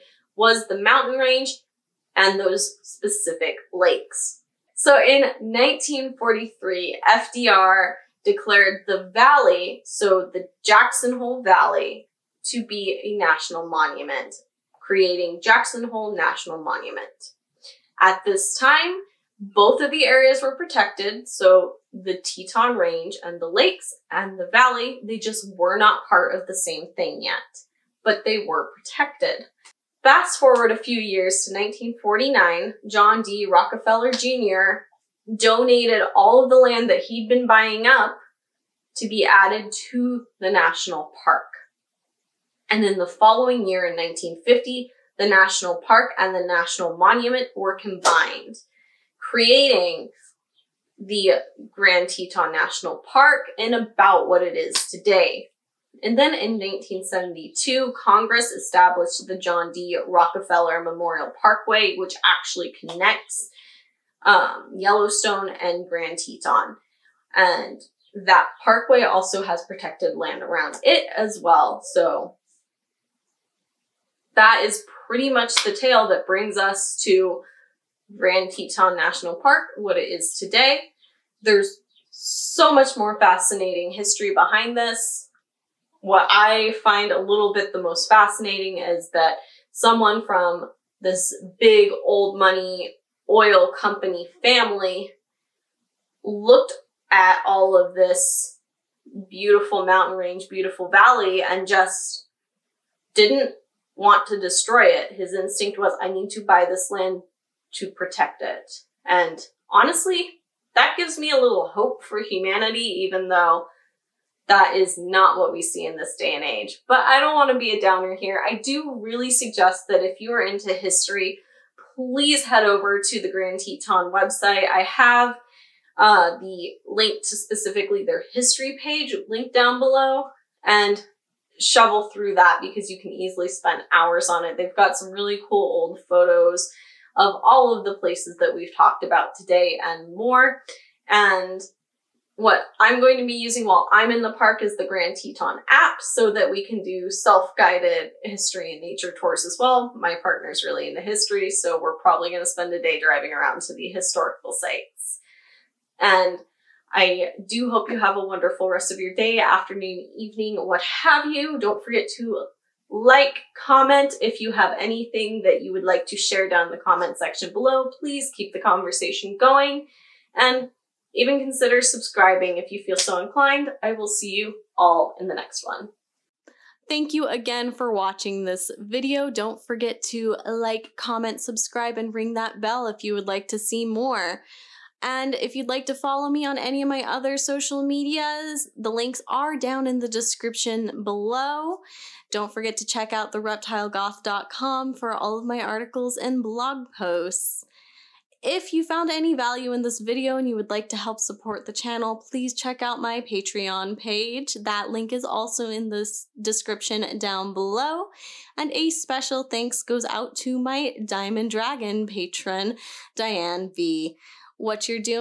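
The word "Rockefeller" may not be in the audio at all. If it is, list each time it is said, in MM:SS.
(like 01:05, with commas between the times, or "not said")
00:33, 01:00.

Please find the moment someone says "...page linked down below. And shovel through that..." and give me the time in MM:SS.
02:08.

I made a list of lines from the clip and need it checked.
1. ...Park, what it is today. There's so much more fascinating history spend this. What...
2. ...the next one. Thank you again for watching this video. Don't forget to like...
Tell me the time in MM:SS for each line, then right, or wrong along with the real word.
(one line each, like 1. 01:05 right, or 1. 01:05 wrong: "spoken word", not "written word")
1. 01:19 wrong: "behind", not "spend"
2. 02:55 right.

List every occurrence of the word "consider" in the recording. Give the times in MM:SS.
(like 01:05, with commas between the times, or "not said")
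02:51.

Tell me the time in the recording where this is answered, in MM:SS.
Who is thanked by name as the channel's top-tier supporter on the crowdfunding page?
03:33.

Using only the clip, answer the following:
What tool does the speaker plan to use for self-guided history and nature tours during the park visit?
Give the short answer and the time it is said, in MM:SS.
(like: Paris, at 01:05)
Grand Teton app, at 02:24.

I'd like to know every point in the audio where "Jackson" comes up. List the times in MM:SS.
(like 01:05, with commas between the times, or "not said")
00:10, 00:15.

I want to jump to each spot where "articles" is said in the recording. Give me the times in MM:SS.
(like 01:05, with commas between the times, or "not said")
03:15.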